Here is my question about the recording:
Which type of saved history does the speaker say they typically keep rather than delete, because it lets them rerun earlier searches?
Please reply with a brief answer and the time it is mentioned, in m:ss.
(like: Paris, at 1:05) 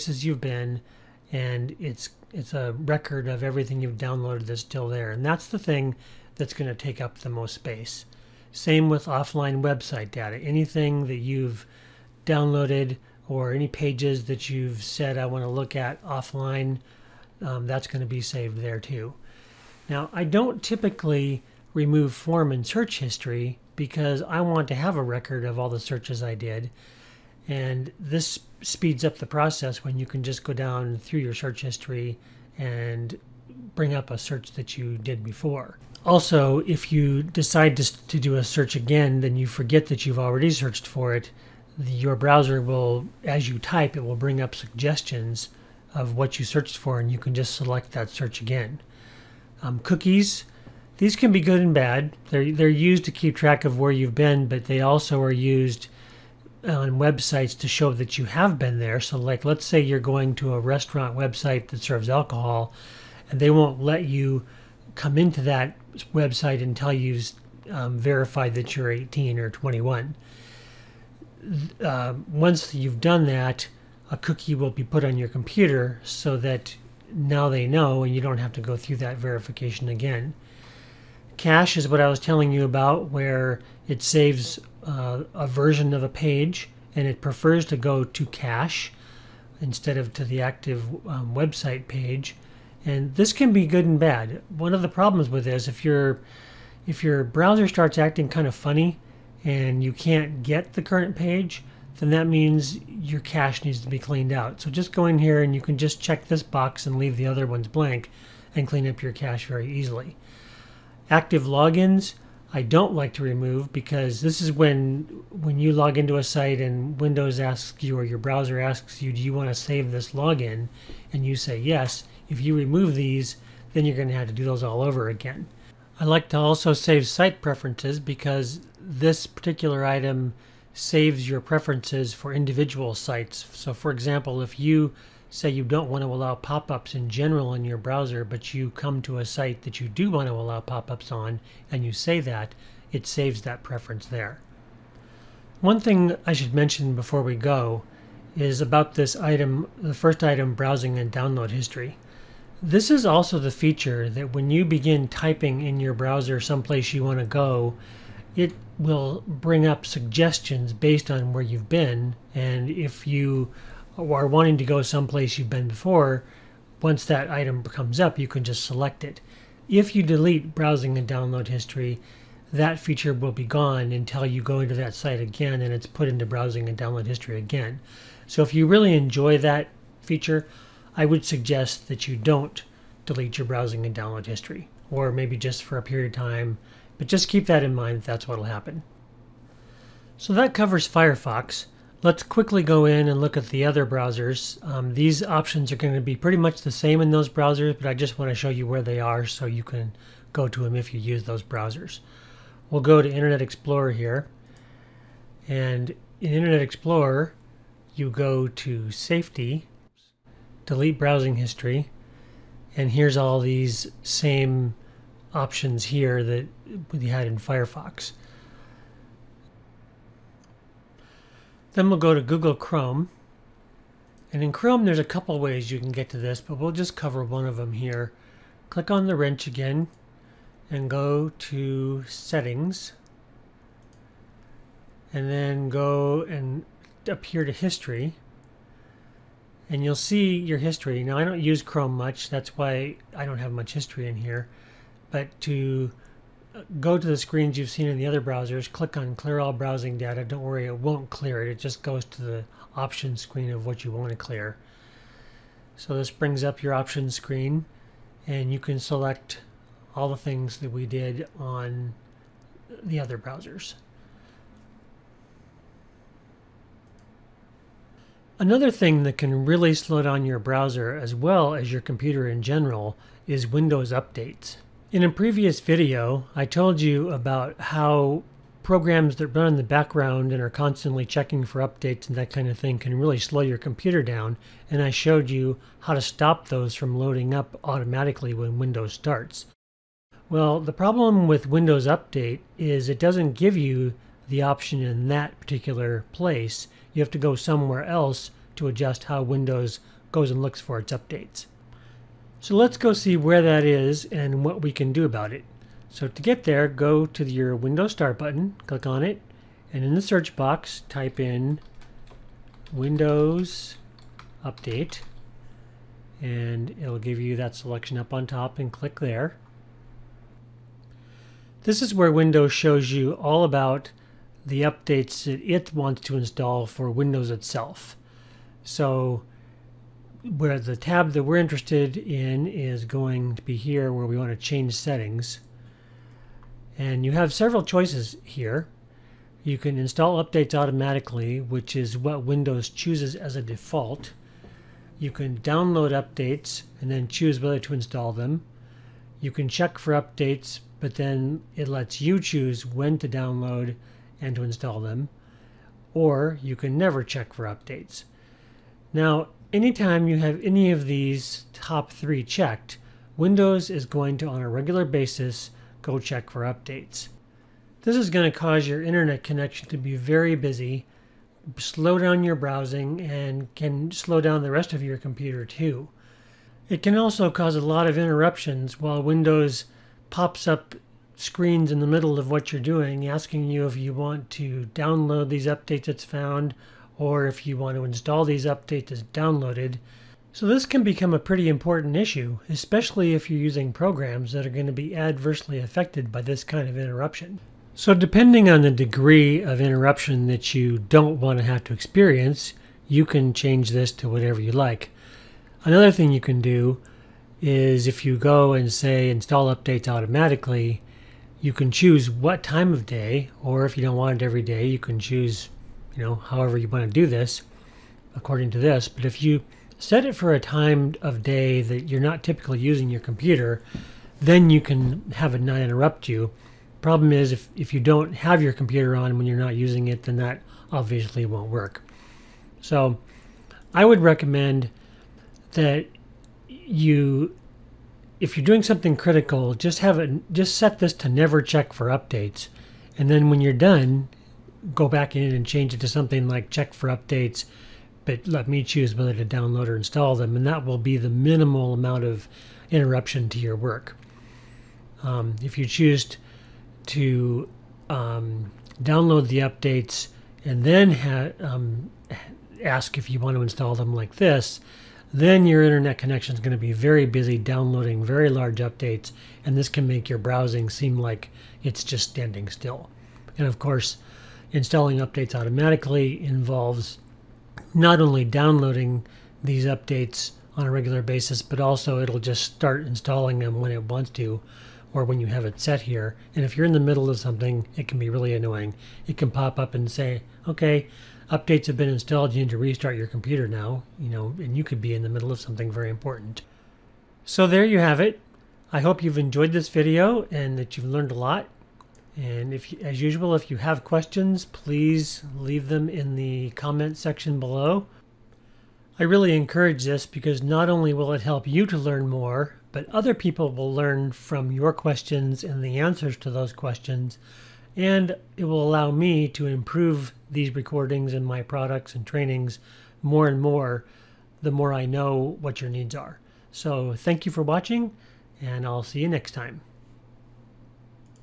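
Form and search history, at 0:22.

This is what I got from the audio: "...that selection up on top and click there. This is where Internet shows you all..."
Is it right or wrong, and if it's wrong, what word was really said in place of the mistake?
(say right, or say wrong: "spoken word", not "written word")
wrong: "Windows", not "Internet".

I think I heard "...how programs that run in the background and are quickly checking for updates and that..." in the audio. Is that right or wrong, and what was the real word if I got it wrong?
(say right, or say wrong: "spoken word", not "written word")
wrong: "constantly", not "quickly".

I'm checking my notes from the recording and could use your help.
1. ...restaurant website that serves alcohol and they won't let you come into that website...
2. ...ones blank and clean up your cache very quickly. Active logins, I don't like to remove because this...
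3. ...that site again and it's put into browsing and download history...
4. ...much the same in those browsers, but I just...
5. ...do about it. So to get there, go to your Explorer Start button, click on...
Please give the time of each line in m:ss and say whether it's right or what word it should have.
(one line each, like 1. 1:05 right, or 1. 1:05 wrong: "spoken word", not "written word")
1. 1:00 right
2. 1:47 wrong: "easily", not "quickly"
3. 2:54 right
4. 3:16 right
5. 5:04 wrong: "Windows", not "Explorer".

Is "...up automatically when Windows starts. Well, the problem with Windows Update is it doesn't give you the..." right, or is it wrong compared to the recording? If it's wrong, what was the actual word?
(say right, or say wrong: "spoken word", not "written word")
right.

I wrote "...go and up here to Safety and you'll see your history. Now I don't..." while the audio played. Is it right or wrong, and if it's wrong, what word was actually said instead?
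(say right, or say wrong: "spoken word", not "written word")
wrong: "History", not "Safety".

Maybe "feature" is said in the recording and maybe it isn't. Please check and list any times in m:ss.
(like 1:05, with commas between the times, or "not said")
2:33, 2:52, 3:00.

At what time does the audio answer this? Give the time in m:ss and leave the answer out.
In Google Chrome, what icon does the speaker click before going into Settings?
3:49.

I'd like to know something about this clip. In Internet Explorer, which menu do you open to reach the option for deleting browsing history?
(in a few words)
Safety.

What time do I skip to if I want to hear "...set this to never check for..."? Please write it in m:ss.
7:20.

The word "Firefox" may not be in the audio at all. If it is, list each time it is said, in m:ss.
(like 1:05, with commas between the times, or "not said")
3:10, 3:37.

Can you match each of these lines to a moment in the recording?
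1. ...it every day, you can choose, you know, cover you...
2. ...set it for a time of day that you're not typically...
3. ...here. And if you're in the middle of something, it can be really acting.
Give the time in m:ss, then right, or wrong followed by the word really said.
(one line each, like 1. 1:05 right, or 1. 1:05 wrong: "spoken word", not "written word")
1. 6:54 wrong: "however", not "cover"
2. 6:59 right
3. 8:05 wrong: "annoying", not "acting".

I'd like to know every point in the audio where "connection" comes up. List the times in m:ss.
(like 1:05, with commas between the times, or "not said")
6:09, 7:45.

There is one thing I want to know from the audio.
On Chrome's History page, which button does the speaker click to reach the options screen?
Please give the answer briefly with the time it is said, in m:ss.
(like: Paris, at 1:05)
Clear all browsing data, at 4:09.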